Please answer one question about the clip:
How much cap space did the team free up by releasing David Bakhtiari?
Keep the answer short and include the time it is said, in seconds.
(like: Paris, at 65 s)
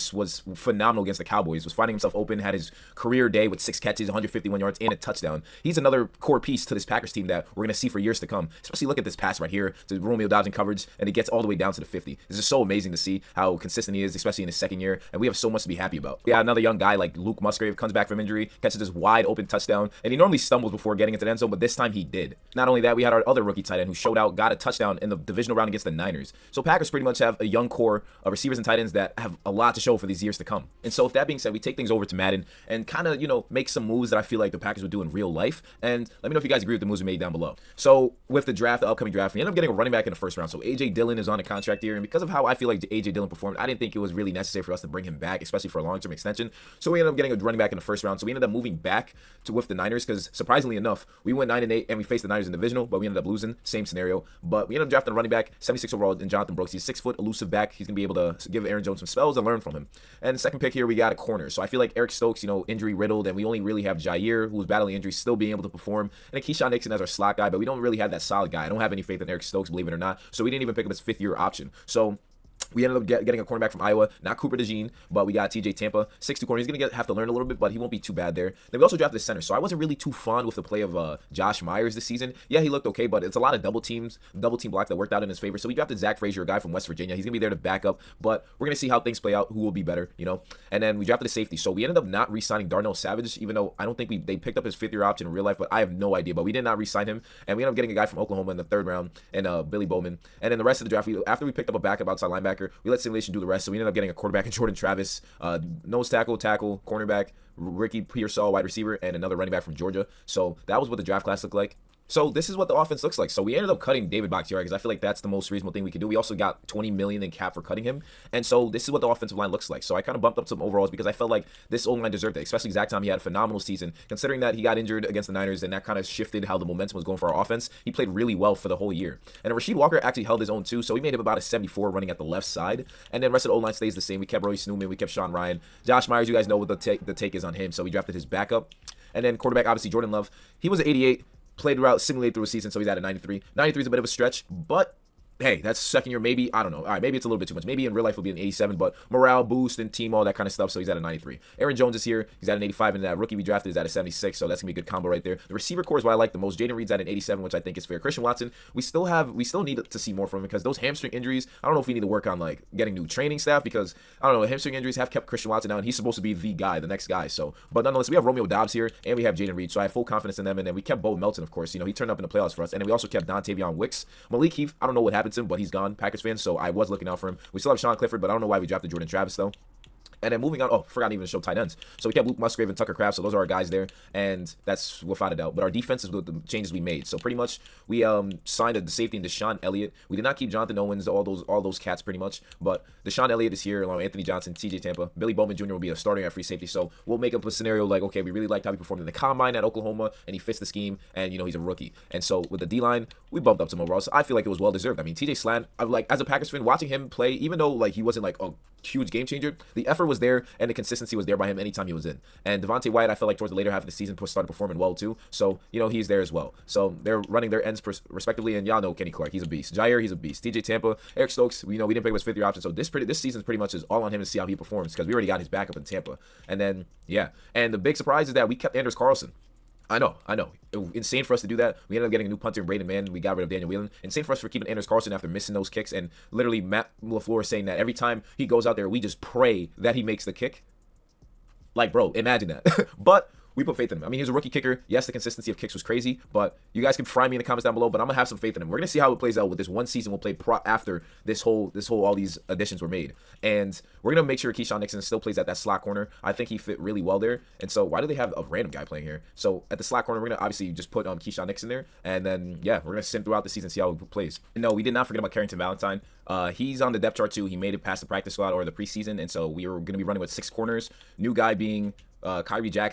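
20 million, at 116 s.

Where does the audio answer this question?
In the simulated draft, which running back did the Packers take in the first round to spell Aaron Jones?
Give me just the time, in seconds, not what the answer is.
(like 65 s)
56 s.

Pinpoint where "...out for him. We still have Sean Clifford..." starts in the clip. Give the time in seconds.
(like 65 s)
177 s.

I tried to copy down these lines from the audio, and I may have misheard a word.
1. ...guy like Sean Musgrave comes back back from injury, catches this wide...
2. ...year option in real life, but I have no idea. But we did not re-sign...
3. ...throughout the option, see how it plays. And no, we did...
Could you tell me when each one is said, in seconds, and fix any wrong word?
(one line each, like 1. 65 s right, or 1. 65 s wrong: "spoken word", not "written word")
1. 16 s wrong: "Luke", not "Sean"
2. 94 s right
3. 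263 s wrong: "season", not "option".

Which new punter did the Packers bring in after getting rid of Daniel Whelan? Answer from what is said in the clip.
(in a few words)
Braden Mann.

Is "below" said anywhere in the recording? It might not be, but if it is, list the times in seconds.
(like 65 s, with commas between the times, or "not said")
37 s, 247 s.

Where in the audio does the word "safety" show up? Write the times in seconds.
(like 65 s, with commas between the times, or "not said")
91 s, 188 s, 196 s.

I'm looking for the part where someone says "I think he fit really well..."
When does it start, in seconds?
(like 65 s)
256 s.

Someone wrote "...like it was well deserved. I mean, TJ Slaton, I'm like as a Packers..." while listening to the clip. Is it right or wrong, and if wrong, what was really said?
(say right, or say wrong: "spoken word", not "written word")
right.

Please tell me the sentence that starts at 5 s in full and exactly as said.
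He's another core piece to this Packers team that we're going to see for years to come.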